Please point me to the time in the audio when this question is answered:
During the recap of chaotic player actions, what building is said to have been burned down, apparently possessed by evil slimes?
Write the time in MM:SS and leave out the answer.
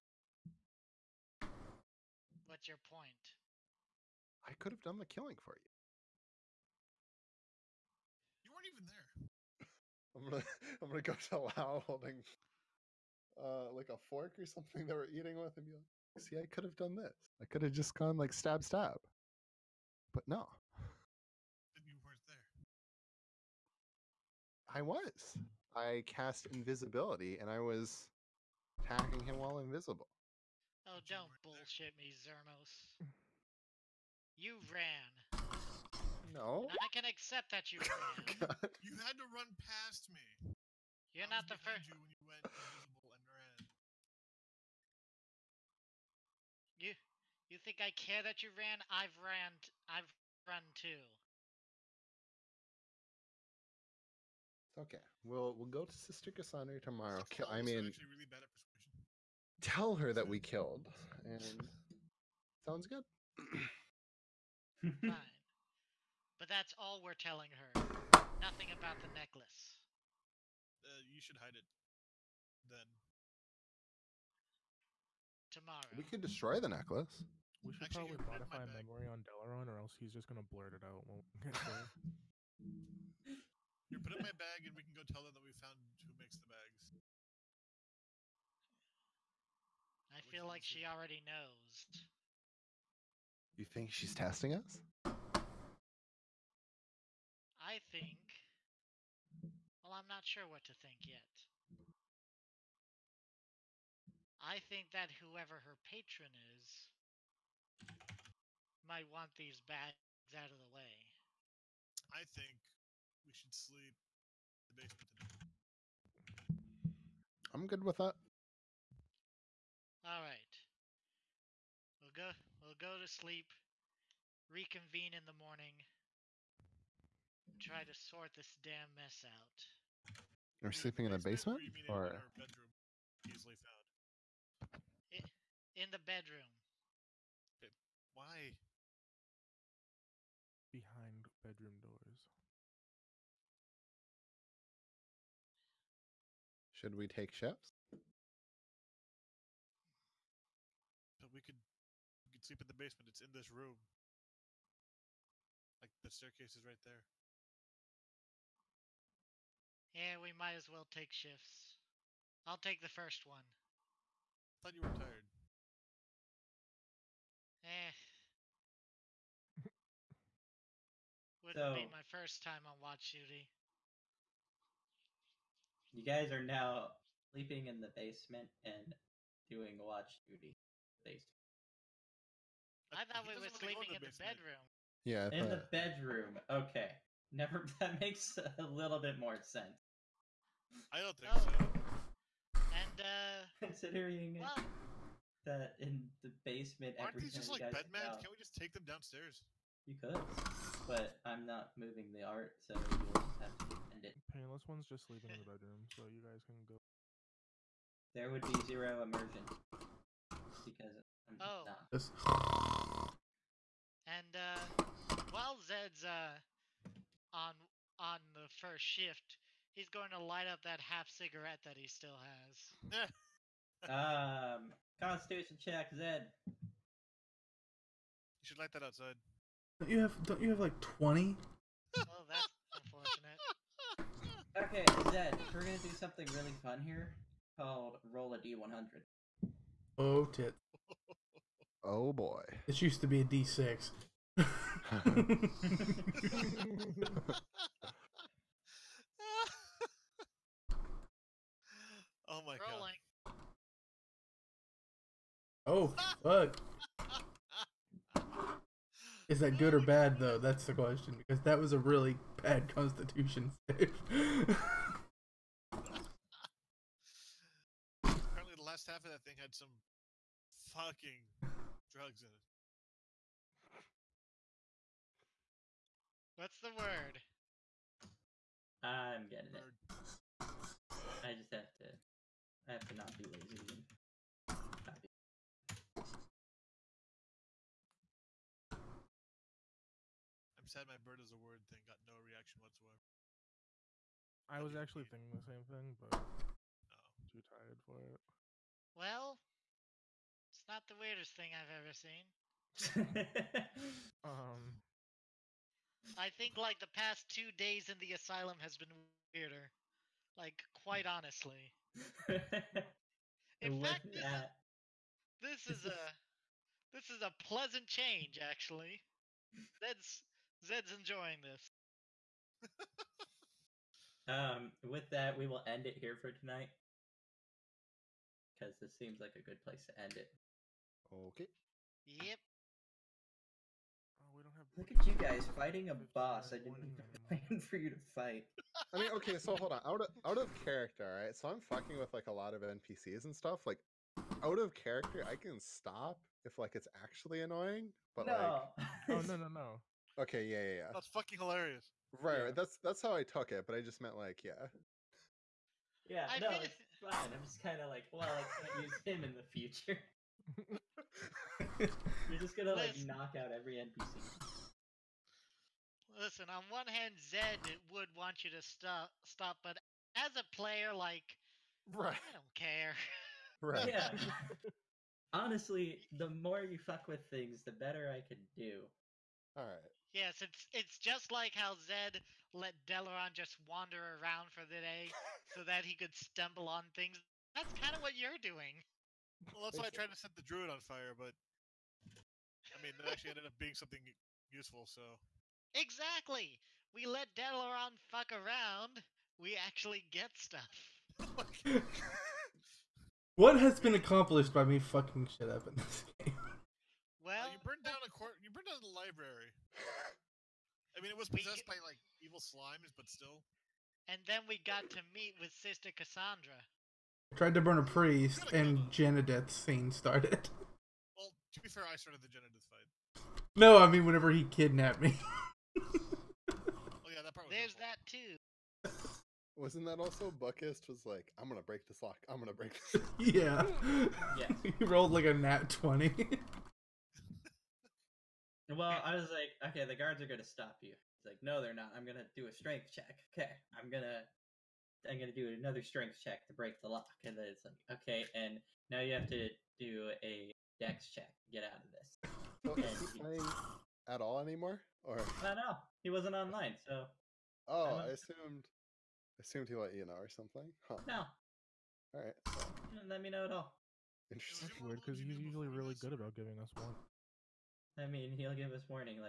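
06:48.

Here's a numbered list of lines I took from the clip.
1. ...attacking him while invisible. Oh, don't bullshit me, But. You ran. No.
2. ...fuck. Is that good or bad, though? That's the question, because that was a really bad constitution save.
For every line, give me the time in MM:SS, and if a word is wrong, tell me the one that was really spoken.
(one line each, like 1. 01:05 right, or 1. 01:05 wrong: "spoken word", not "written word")
1. 00:28 wrong: "Zermos", not "But"
2. 04:16 right.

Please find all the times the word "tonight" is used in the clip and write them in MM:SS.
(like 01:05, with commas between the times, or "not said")
01:55, 05:26.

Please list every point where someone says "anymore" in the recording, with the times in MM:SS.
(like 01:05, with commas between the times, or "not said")
07:34.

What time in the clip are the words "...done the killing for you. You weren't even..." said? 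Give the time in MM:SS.
00:04.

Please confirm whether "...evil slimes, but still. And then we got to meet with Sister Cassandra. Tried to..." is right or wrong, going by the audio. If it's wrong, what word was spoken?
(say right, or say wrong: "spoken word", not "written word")
right.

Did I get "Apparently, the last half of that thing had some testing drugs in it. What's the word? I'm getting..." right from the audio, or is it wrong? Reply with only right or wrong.
wrong.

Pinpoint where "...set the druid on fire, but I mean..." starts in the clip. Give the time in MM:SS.
06:30.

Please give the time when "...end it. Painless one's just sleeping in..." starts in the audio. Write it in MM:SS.
03:23.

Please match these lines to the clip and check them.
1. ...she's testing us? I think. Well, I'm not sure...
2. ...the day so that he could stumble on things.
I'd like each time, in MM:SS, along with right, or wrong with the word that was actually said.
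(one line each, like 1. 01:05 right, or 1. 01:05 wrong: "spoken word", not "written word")
1. 01:33 right
2. 06:24 right.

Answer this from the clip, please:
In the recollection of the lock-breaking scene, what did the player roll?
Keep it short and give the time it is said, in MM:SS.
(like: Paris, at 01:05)
nat 20, at 07:15.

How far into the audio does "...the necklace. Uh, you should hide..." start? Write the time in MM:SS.
01:09.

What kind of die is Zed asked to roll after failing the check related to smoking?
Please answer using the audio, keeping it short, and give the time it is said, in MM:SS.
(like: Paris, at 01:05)
d100, at 03:58.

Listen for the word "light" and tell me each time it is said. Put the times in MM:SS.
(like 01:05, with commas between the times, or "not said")
03:40, 03:48.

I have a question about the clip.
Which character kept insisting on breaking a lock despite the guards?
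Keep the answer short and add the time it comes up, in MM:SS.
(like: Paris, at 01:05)
Buckist, at 07:10.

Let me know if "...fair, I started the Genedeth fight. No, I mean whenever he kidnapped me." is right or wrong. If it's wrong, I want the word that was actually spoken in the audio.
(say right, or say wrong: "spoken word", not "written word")
right.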